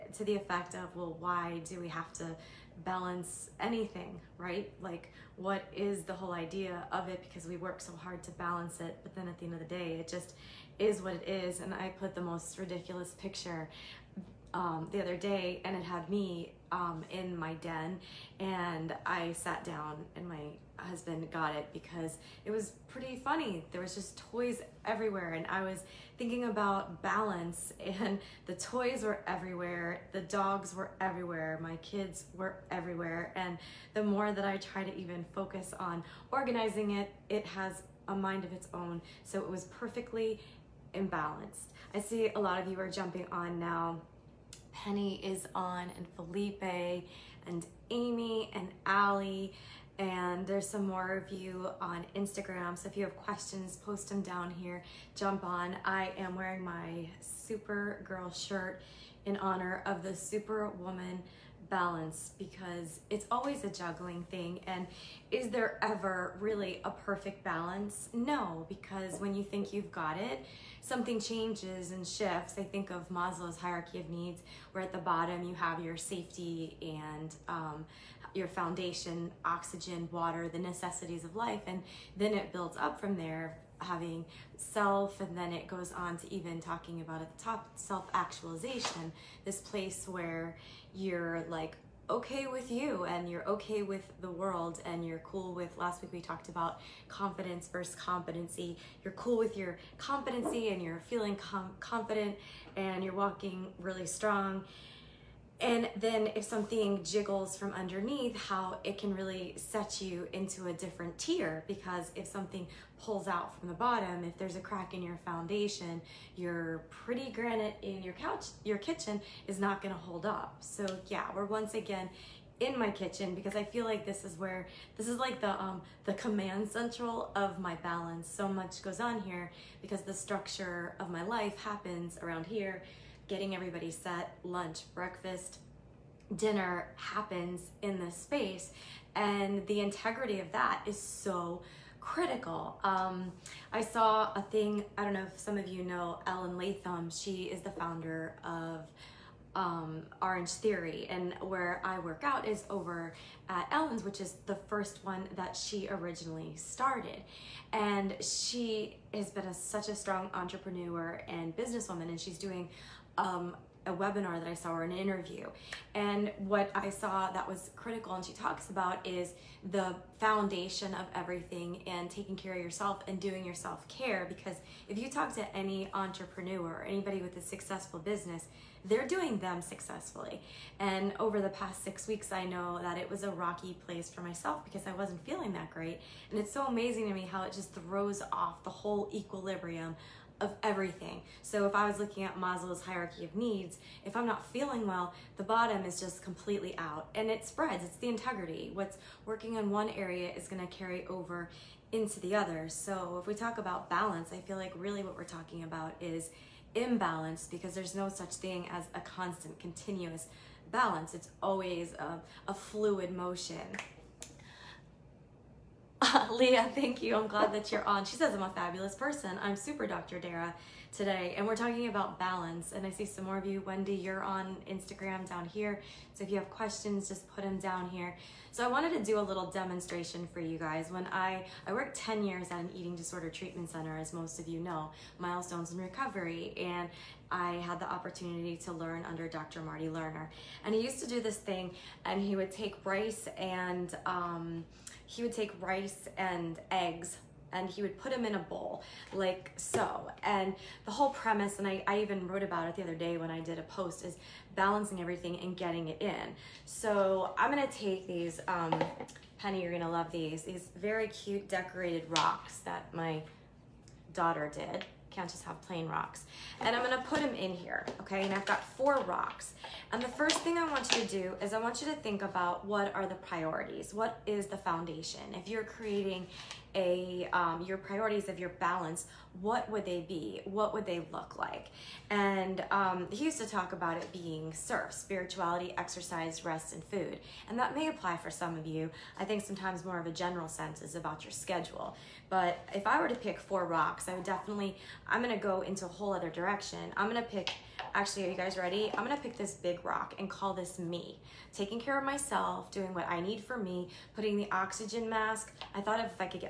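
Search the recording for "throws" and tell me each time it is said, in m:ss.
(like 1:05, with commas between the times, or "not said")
3:07.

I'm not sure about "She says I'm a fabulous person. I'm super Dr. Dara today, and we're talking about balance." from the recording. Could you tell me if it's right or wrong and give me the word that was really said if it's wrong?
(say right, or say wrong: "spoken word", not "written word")
right.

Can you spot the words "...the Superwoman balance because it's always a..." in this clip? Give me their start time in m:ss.
1:00.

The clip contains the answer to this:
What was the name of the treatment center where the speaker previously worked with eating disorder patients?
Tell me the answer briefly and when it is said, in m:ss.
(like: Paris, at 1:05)
Milestones in Recovery, at 3:55.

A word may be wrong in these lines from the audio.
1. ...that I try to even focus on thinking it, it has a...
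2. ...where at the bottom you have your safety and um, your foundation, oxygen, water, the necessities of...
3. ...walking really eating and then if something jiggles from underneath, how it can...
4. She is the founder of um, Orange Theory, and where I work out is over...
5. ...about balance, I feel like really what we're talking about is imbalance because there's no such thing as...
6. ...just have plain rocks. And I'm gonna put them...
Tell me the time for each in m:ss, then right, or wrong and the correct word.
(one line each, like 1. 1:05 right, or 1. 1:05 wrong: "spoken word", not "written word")
1. 0:34 wrong: "organizing", not "thinking"
2. 1:14 right
3. 1:43 wrong: "strong", not "eating"
4. 2:27 right
5. 3:23 right
6. 4:25 right.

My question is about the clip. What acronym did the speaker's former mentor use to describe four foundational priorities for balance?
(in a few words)
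SERF.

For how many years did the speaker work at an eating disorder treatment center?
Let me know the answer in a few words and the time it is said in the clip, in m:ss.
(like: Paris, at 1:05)
10, at 3:51.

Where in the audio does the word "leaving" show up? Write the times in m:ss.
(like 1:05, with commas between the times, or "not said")
not said.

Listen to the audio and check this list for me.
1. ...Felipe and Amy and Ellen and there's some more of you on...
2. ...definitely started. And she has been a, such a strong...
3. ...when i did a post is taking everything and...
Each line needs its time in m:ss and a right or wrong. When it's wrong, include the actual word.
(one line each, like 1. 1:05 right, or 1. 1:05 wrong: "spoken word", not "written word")
1. 0:46 wrong: "Allie", not "Ellen"
2. 2:35 wrong: "originally", not "definitely"
3. 4:13 wrong: "balancing", not "taking".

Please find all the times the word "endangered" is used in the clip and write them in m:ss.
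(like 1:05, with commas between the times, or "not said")
not said.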